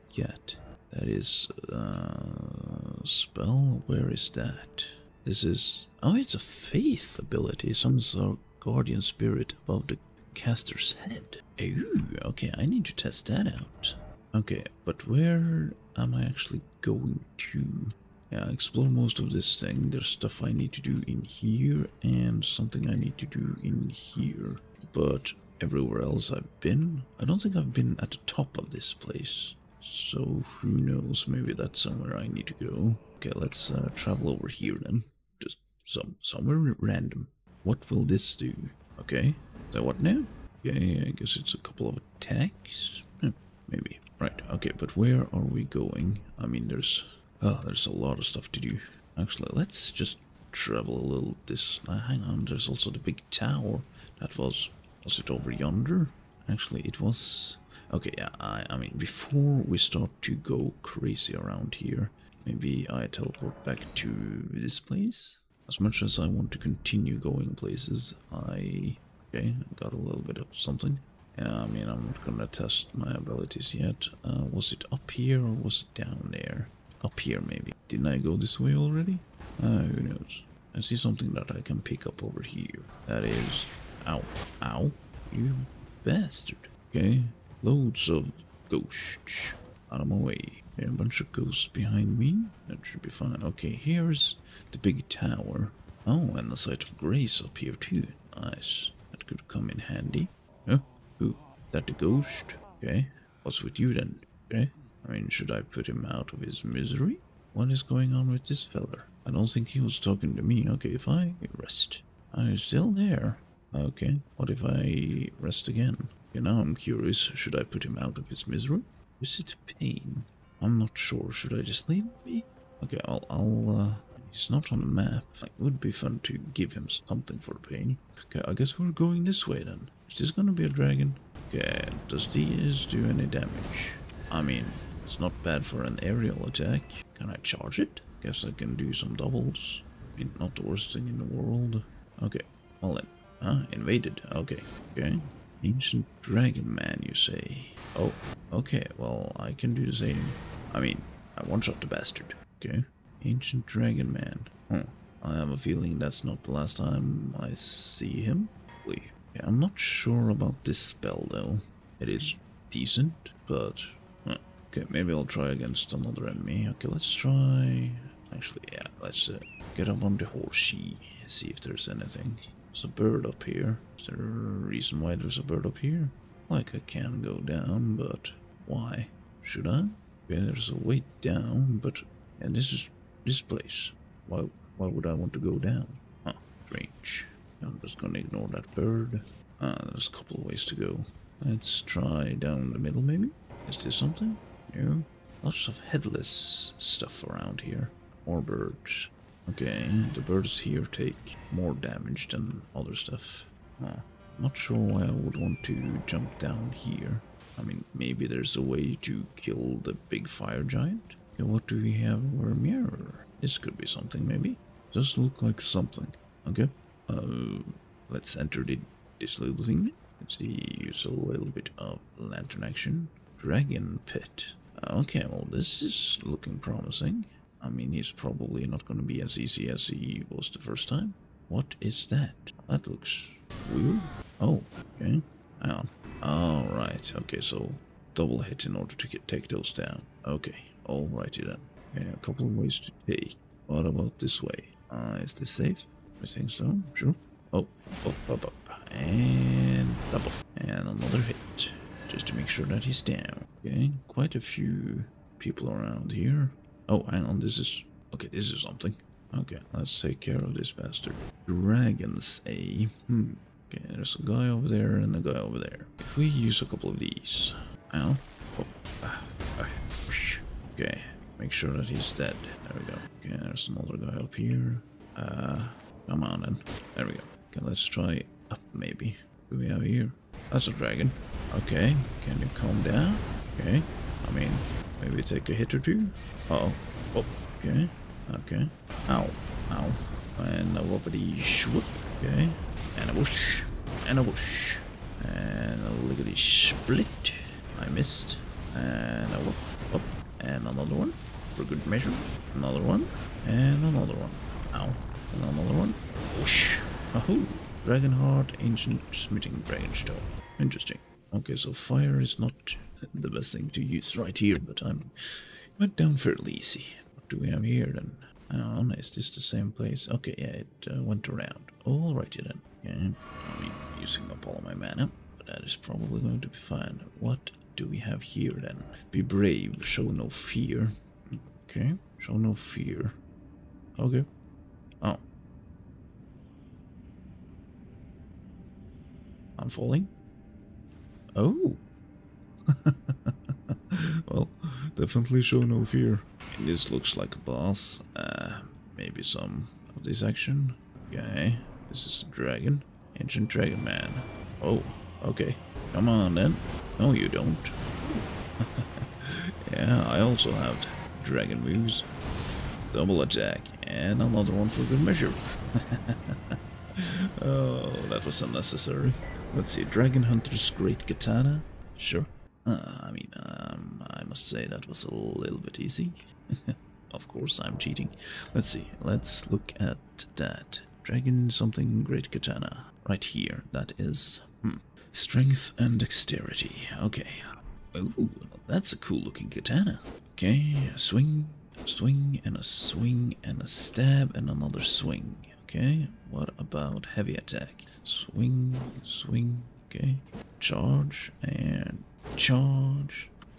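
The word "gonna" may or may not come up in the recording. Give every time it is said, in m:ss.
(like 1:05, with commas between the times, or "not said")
1:12, 2:10, 3:07.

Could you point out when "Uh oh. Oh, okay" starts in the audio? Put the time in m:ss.
4:46.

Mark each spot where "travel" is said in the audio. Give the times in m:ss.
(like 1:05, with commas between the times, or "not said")
0:33, 0:50.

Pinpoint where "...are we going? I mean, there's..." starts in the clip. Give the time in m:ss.
0:45.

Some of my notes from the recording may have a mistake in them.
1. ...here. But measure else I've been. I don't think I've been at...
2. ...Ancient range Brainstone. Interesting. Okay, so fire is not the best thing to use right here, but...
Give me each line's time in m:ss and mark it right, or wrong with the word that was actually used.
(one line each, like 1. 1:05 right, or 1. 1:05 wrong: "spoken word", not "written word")
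1. 0:23 wrong: "everywhere", not "measure"
2. 5:08 right.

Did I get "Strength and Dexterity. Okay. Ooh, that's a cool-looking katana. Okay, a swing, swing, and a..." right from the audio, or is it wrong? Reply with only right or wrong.
right.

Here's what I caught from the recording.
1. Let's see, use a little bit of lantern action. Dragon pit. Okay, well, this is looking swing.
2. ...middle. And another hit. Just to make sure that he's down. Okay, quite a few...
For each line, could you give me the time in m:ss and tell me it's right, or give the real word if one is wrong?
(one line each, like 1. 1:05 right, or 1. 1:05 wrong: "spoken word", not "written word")
1. 3:40 wrong: "promising", not "swing"
2. 4:10 wrong: "double", not "middle".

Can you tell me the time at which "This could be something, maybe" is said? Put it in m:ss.
3:33.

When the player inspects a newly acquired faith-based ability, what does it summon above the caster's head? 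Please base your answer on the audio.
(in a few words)
guardian spirit.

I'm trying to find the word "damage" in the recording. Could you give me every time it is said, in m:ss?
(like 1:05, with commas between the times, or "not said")
2:13, 3:21.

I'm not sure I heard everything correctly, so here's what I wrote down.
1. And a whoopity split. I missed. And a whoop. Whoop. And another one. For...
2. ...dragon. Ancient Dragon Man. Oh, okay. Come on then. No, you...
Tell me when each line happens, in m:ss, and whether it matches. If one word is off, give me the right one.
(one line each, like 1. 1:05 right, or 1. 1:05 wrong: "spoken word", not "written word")
1. 4:55 wrong: "liggity", not "whoopity"
2. 5:52 right.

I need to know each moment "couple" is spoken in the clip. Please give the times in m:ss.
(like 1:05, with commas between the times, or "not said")
0:41, 3:10, 4:02, 4:26.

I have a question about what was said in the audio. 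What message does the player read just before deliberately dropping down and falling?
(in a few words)
Be brave, show no fear.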